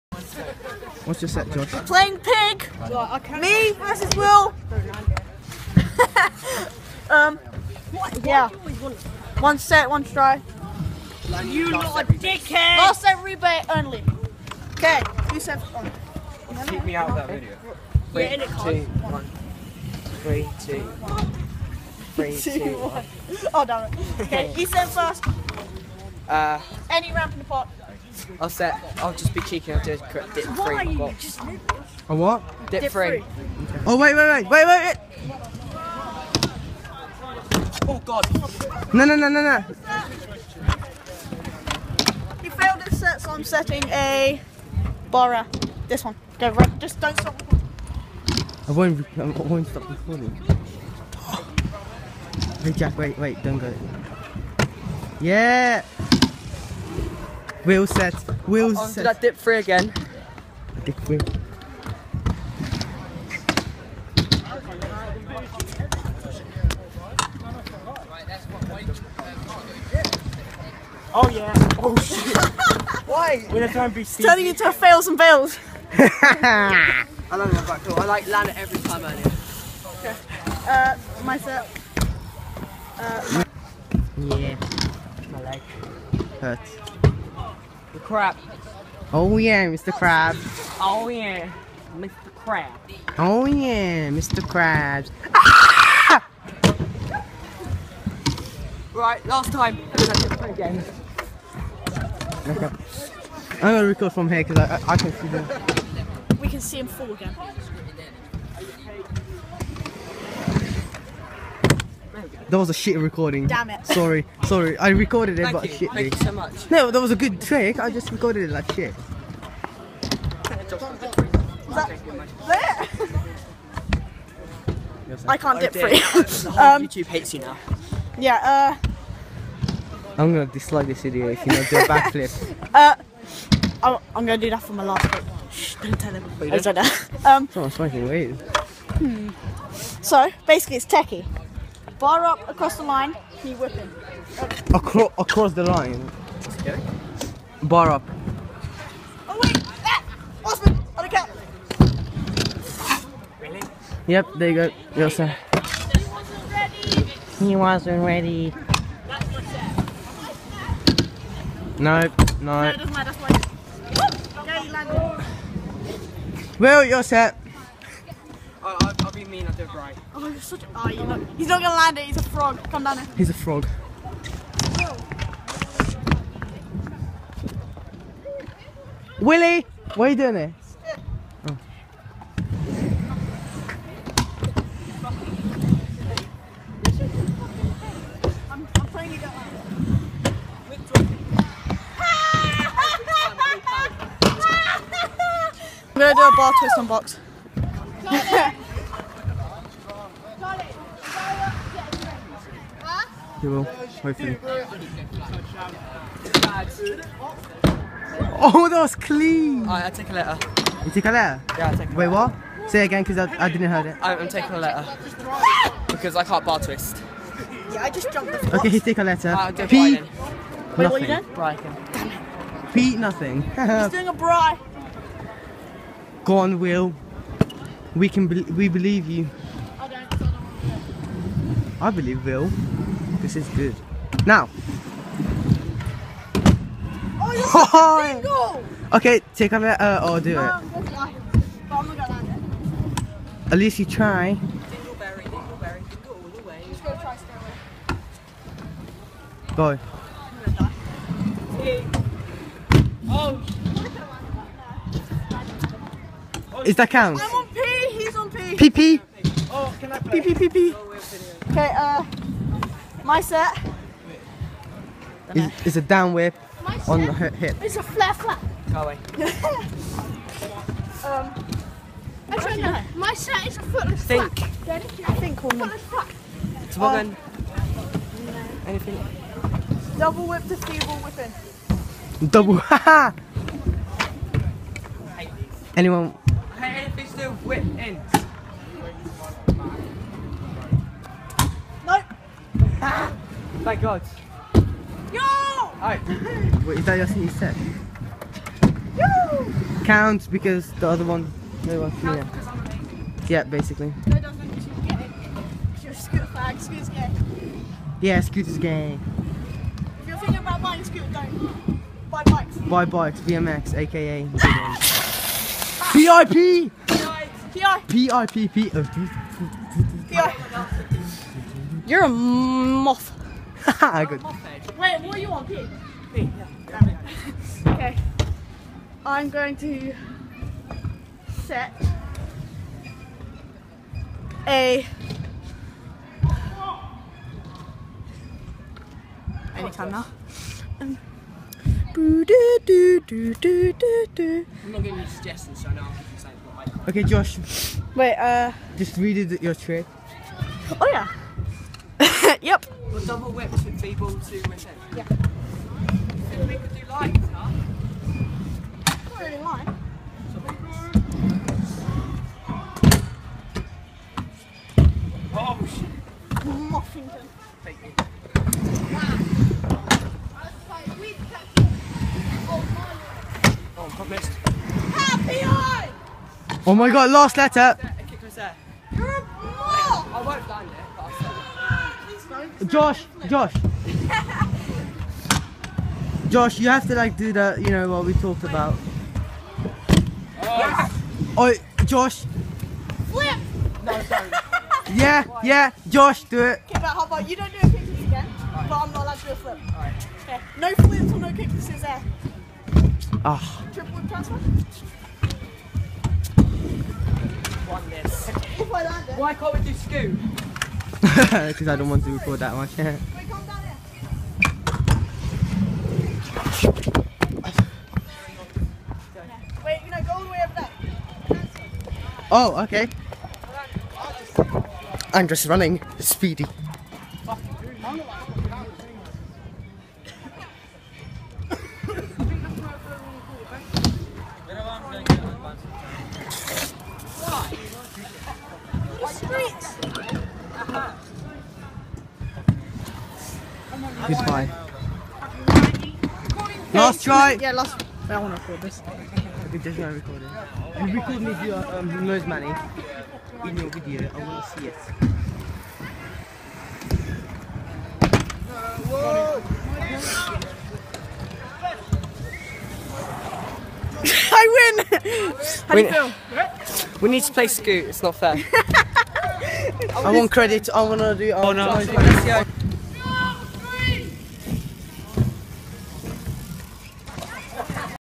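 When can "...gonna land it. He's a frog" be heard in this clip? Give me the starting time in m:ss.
2:51.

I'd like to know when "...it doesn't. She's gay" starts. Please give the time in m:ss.
5:04.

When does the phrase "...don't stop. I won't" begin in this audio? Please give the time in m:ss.
0:46.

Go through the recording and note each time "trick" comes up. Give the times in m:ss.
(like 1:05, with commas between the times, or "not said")
1:57, 5:49.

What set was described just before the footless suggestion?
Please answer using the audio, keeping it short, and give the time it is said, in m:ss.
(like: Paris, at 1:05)
down whip on the hip, at 4:25.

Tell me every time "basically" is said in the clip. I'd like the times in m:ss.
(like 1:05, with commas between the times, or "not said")
2:20, 5:03.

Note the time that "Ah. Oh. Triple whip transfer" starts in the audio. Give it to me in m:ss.
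6:43.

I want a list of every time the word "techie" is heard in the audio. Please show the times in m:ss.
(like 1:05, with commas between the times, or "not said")
2:20.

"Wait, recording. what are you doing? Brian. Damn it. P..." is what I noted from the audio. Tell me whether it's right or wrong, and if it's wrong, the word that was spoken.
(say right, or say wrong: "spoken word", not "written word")
wrong: "nothing", not "recording".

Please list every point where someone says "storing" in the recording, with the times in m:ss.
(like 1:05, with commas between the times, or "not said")
not said.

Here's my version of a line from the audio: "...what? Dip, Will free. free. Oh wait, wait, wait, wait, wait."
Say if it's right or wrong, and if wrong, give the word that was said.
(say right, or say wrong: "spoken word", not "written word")
wrong: "Dip", not "Will".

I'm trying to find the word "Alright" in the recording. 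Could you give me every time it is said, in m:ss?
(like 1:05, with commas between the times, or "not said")
3:29, 4:55.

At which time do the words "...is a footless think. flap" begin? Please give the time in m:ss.
4:33.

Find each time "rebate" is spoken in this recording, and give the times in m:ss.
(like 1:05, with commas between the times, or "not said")
0:13.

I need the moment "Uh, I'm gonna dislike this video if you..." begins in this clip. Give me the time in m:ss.
2:08.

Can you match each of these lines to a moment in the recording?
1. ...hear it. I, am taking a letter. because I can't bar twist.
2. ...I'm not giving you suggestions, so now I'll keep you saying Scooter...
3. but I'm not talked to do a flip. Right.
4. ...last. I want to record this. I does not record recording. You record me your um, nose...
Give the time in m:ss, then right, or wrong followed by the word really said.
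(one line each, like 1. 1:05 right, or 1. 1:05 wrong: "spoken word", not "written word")
1. 3:33 right
2. 5:41 wrong: "Okay", not "Scooter"
3. 6:38 wrong: "allowed", not "talked"
4. 7:27 right.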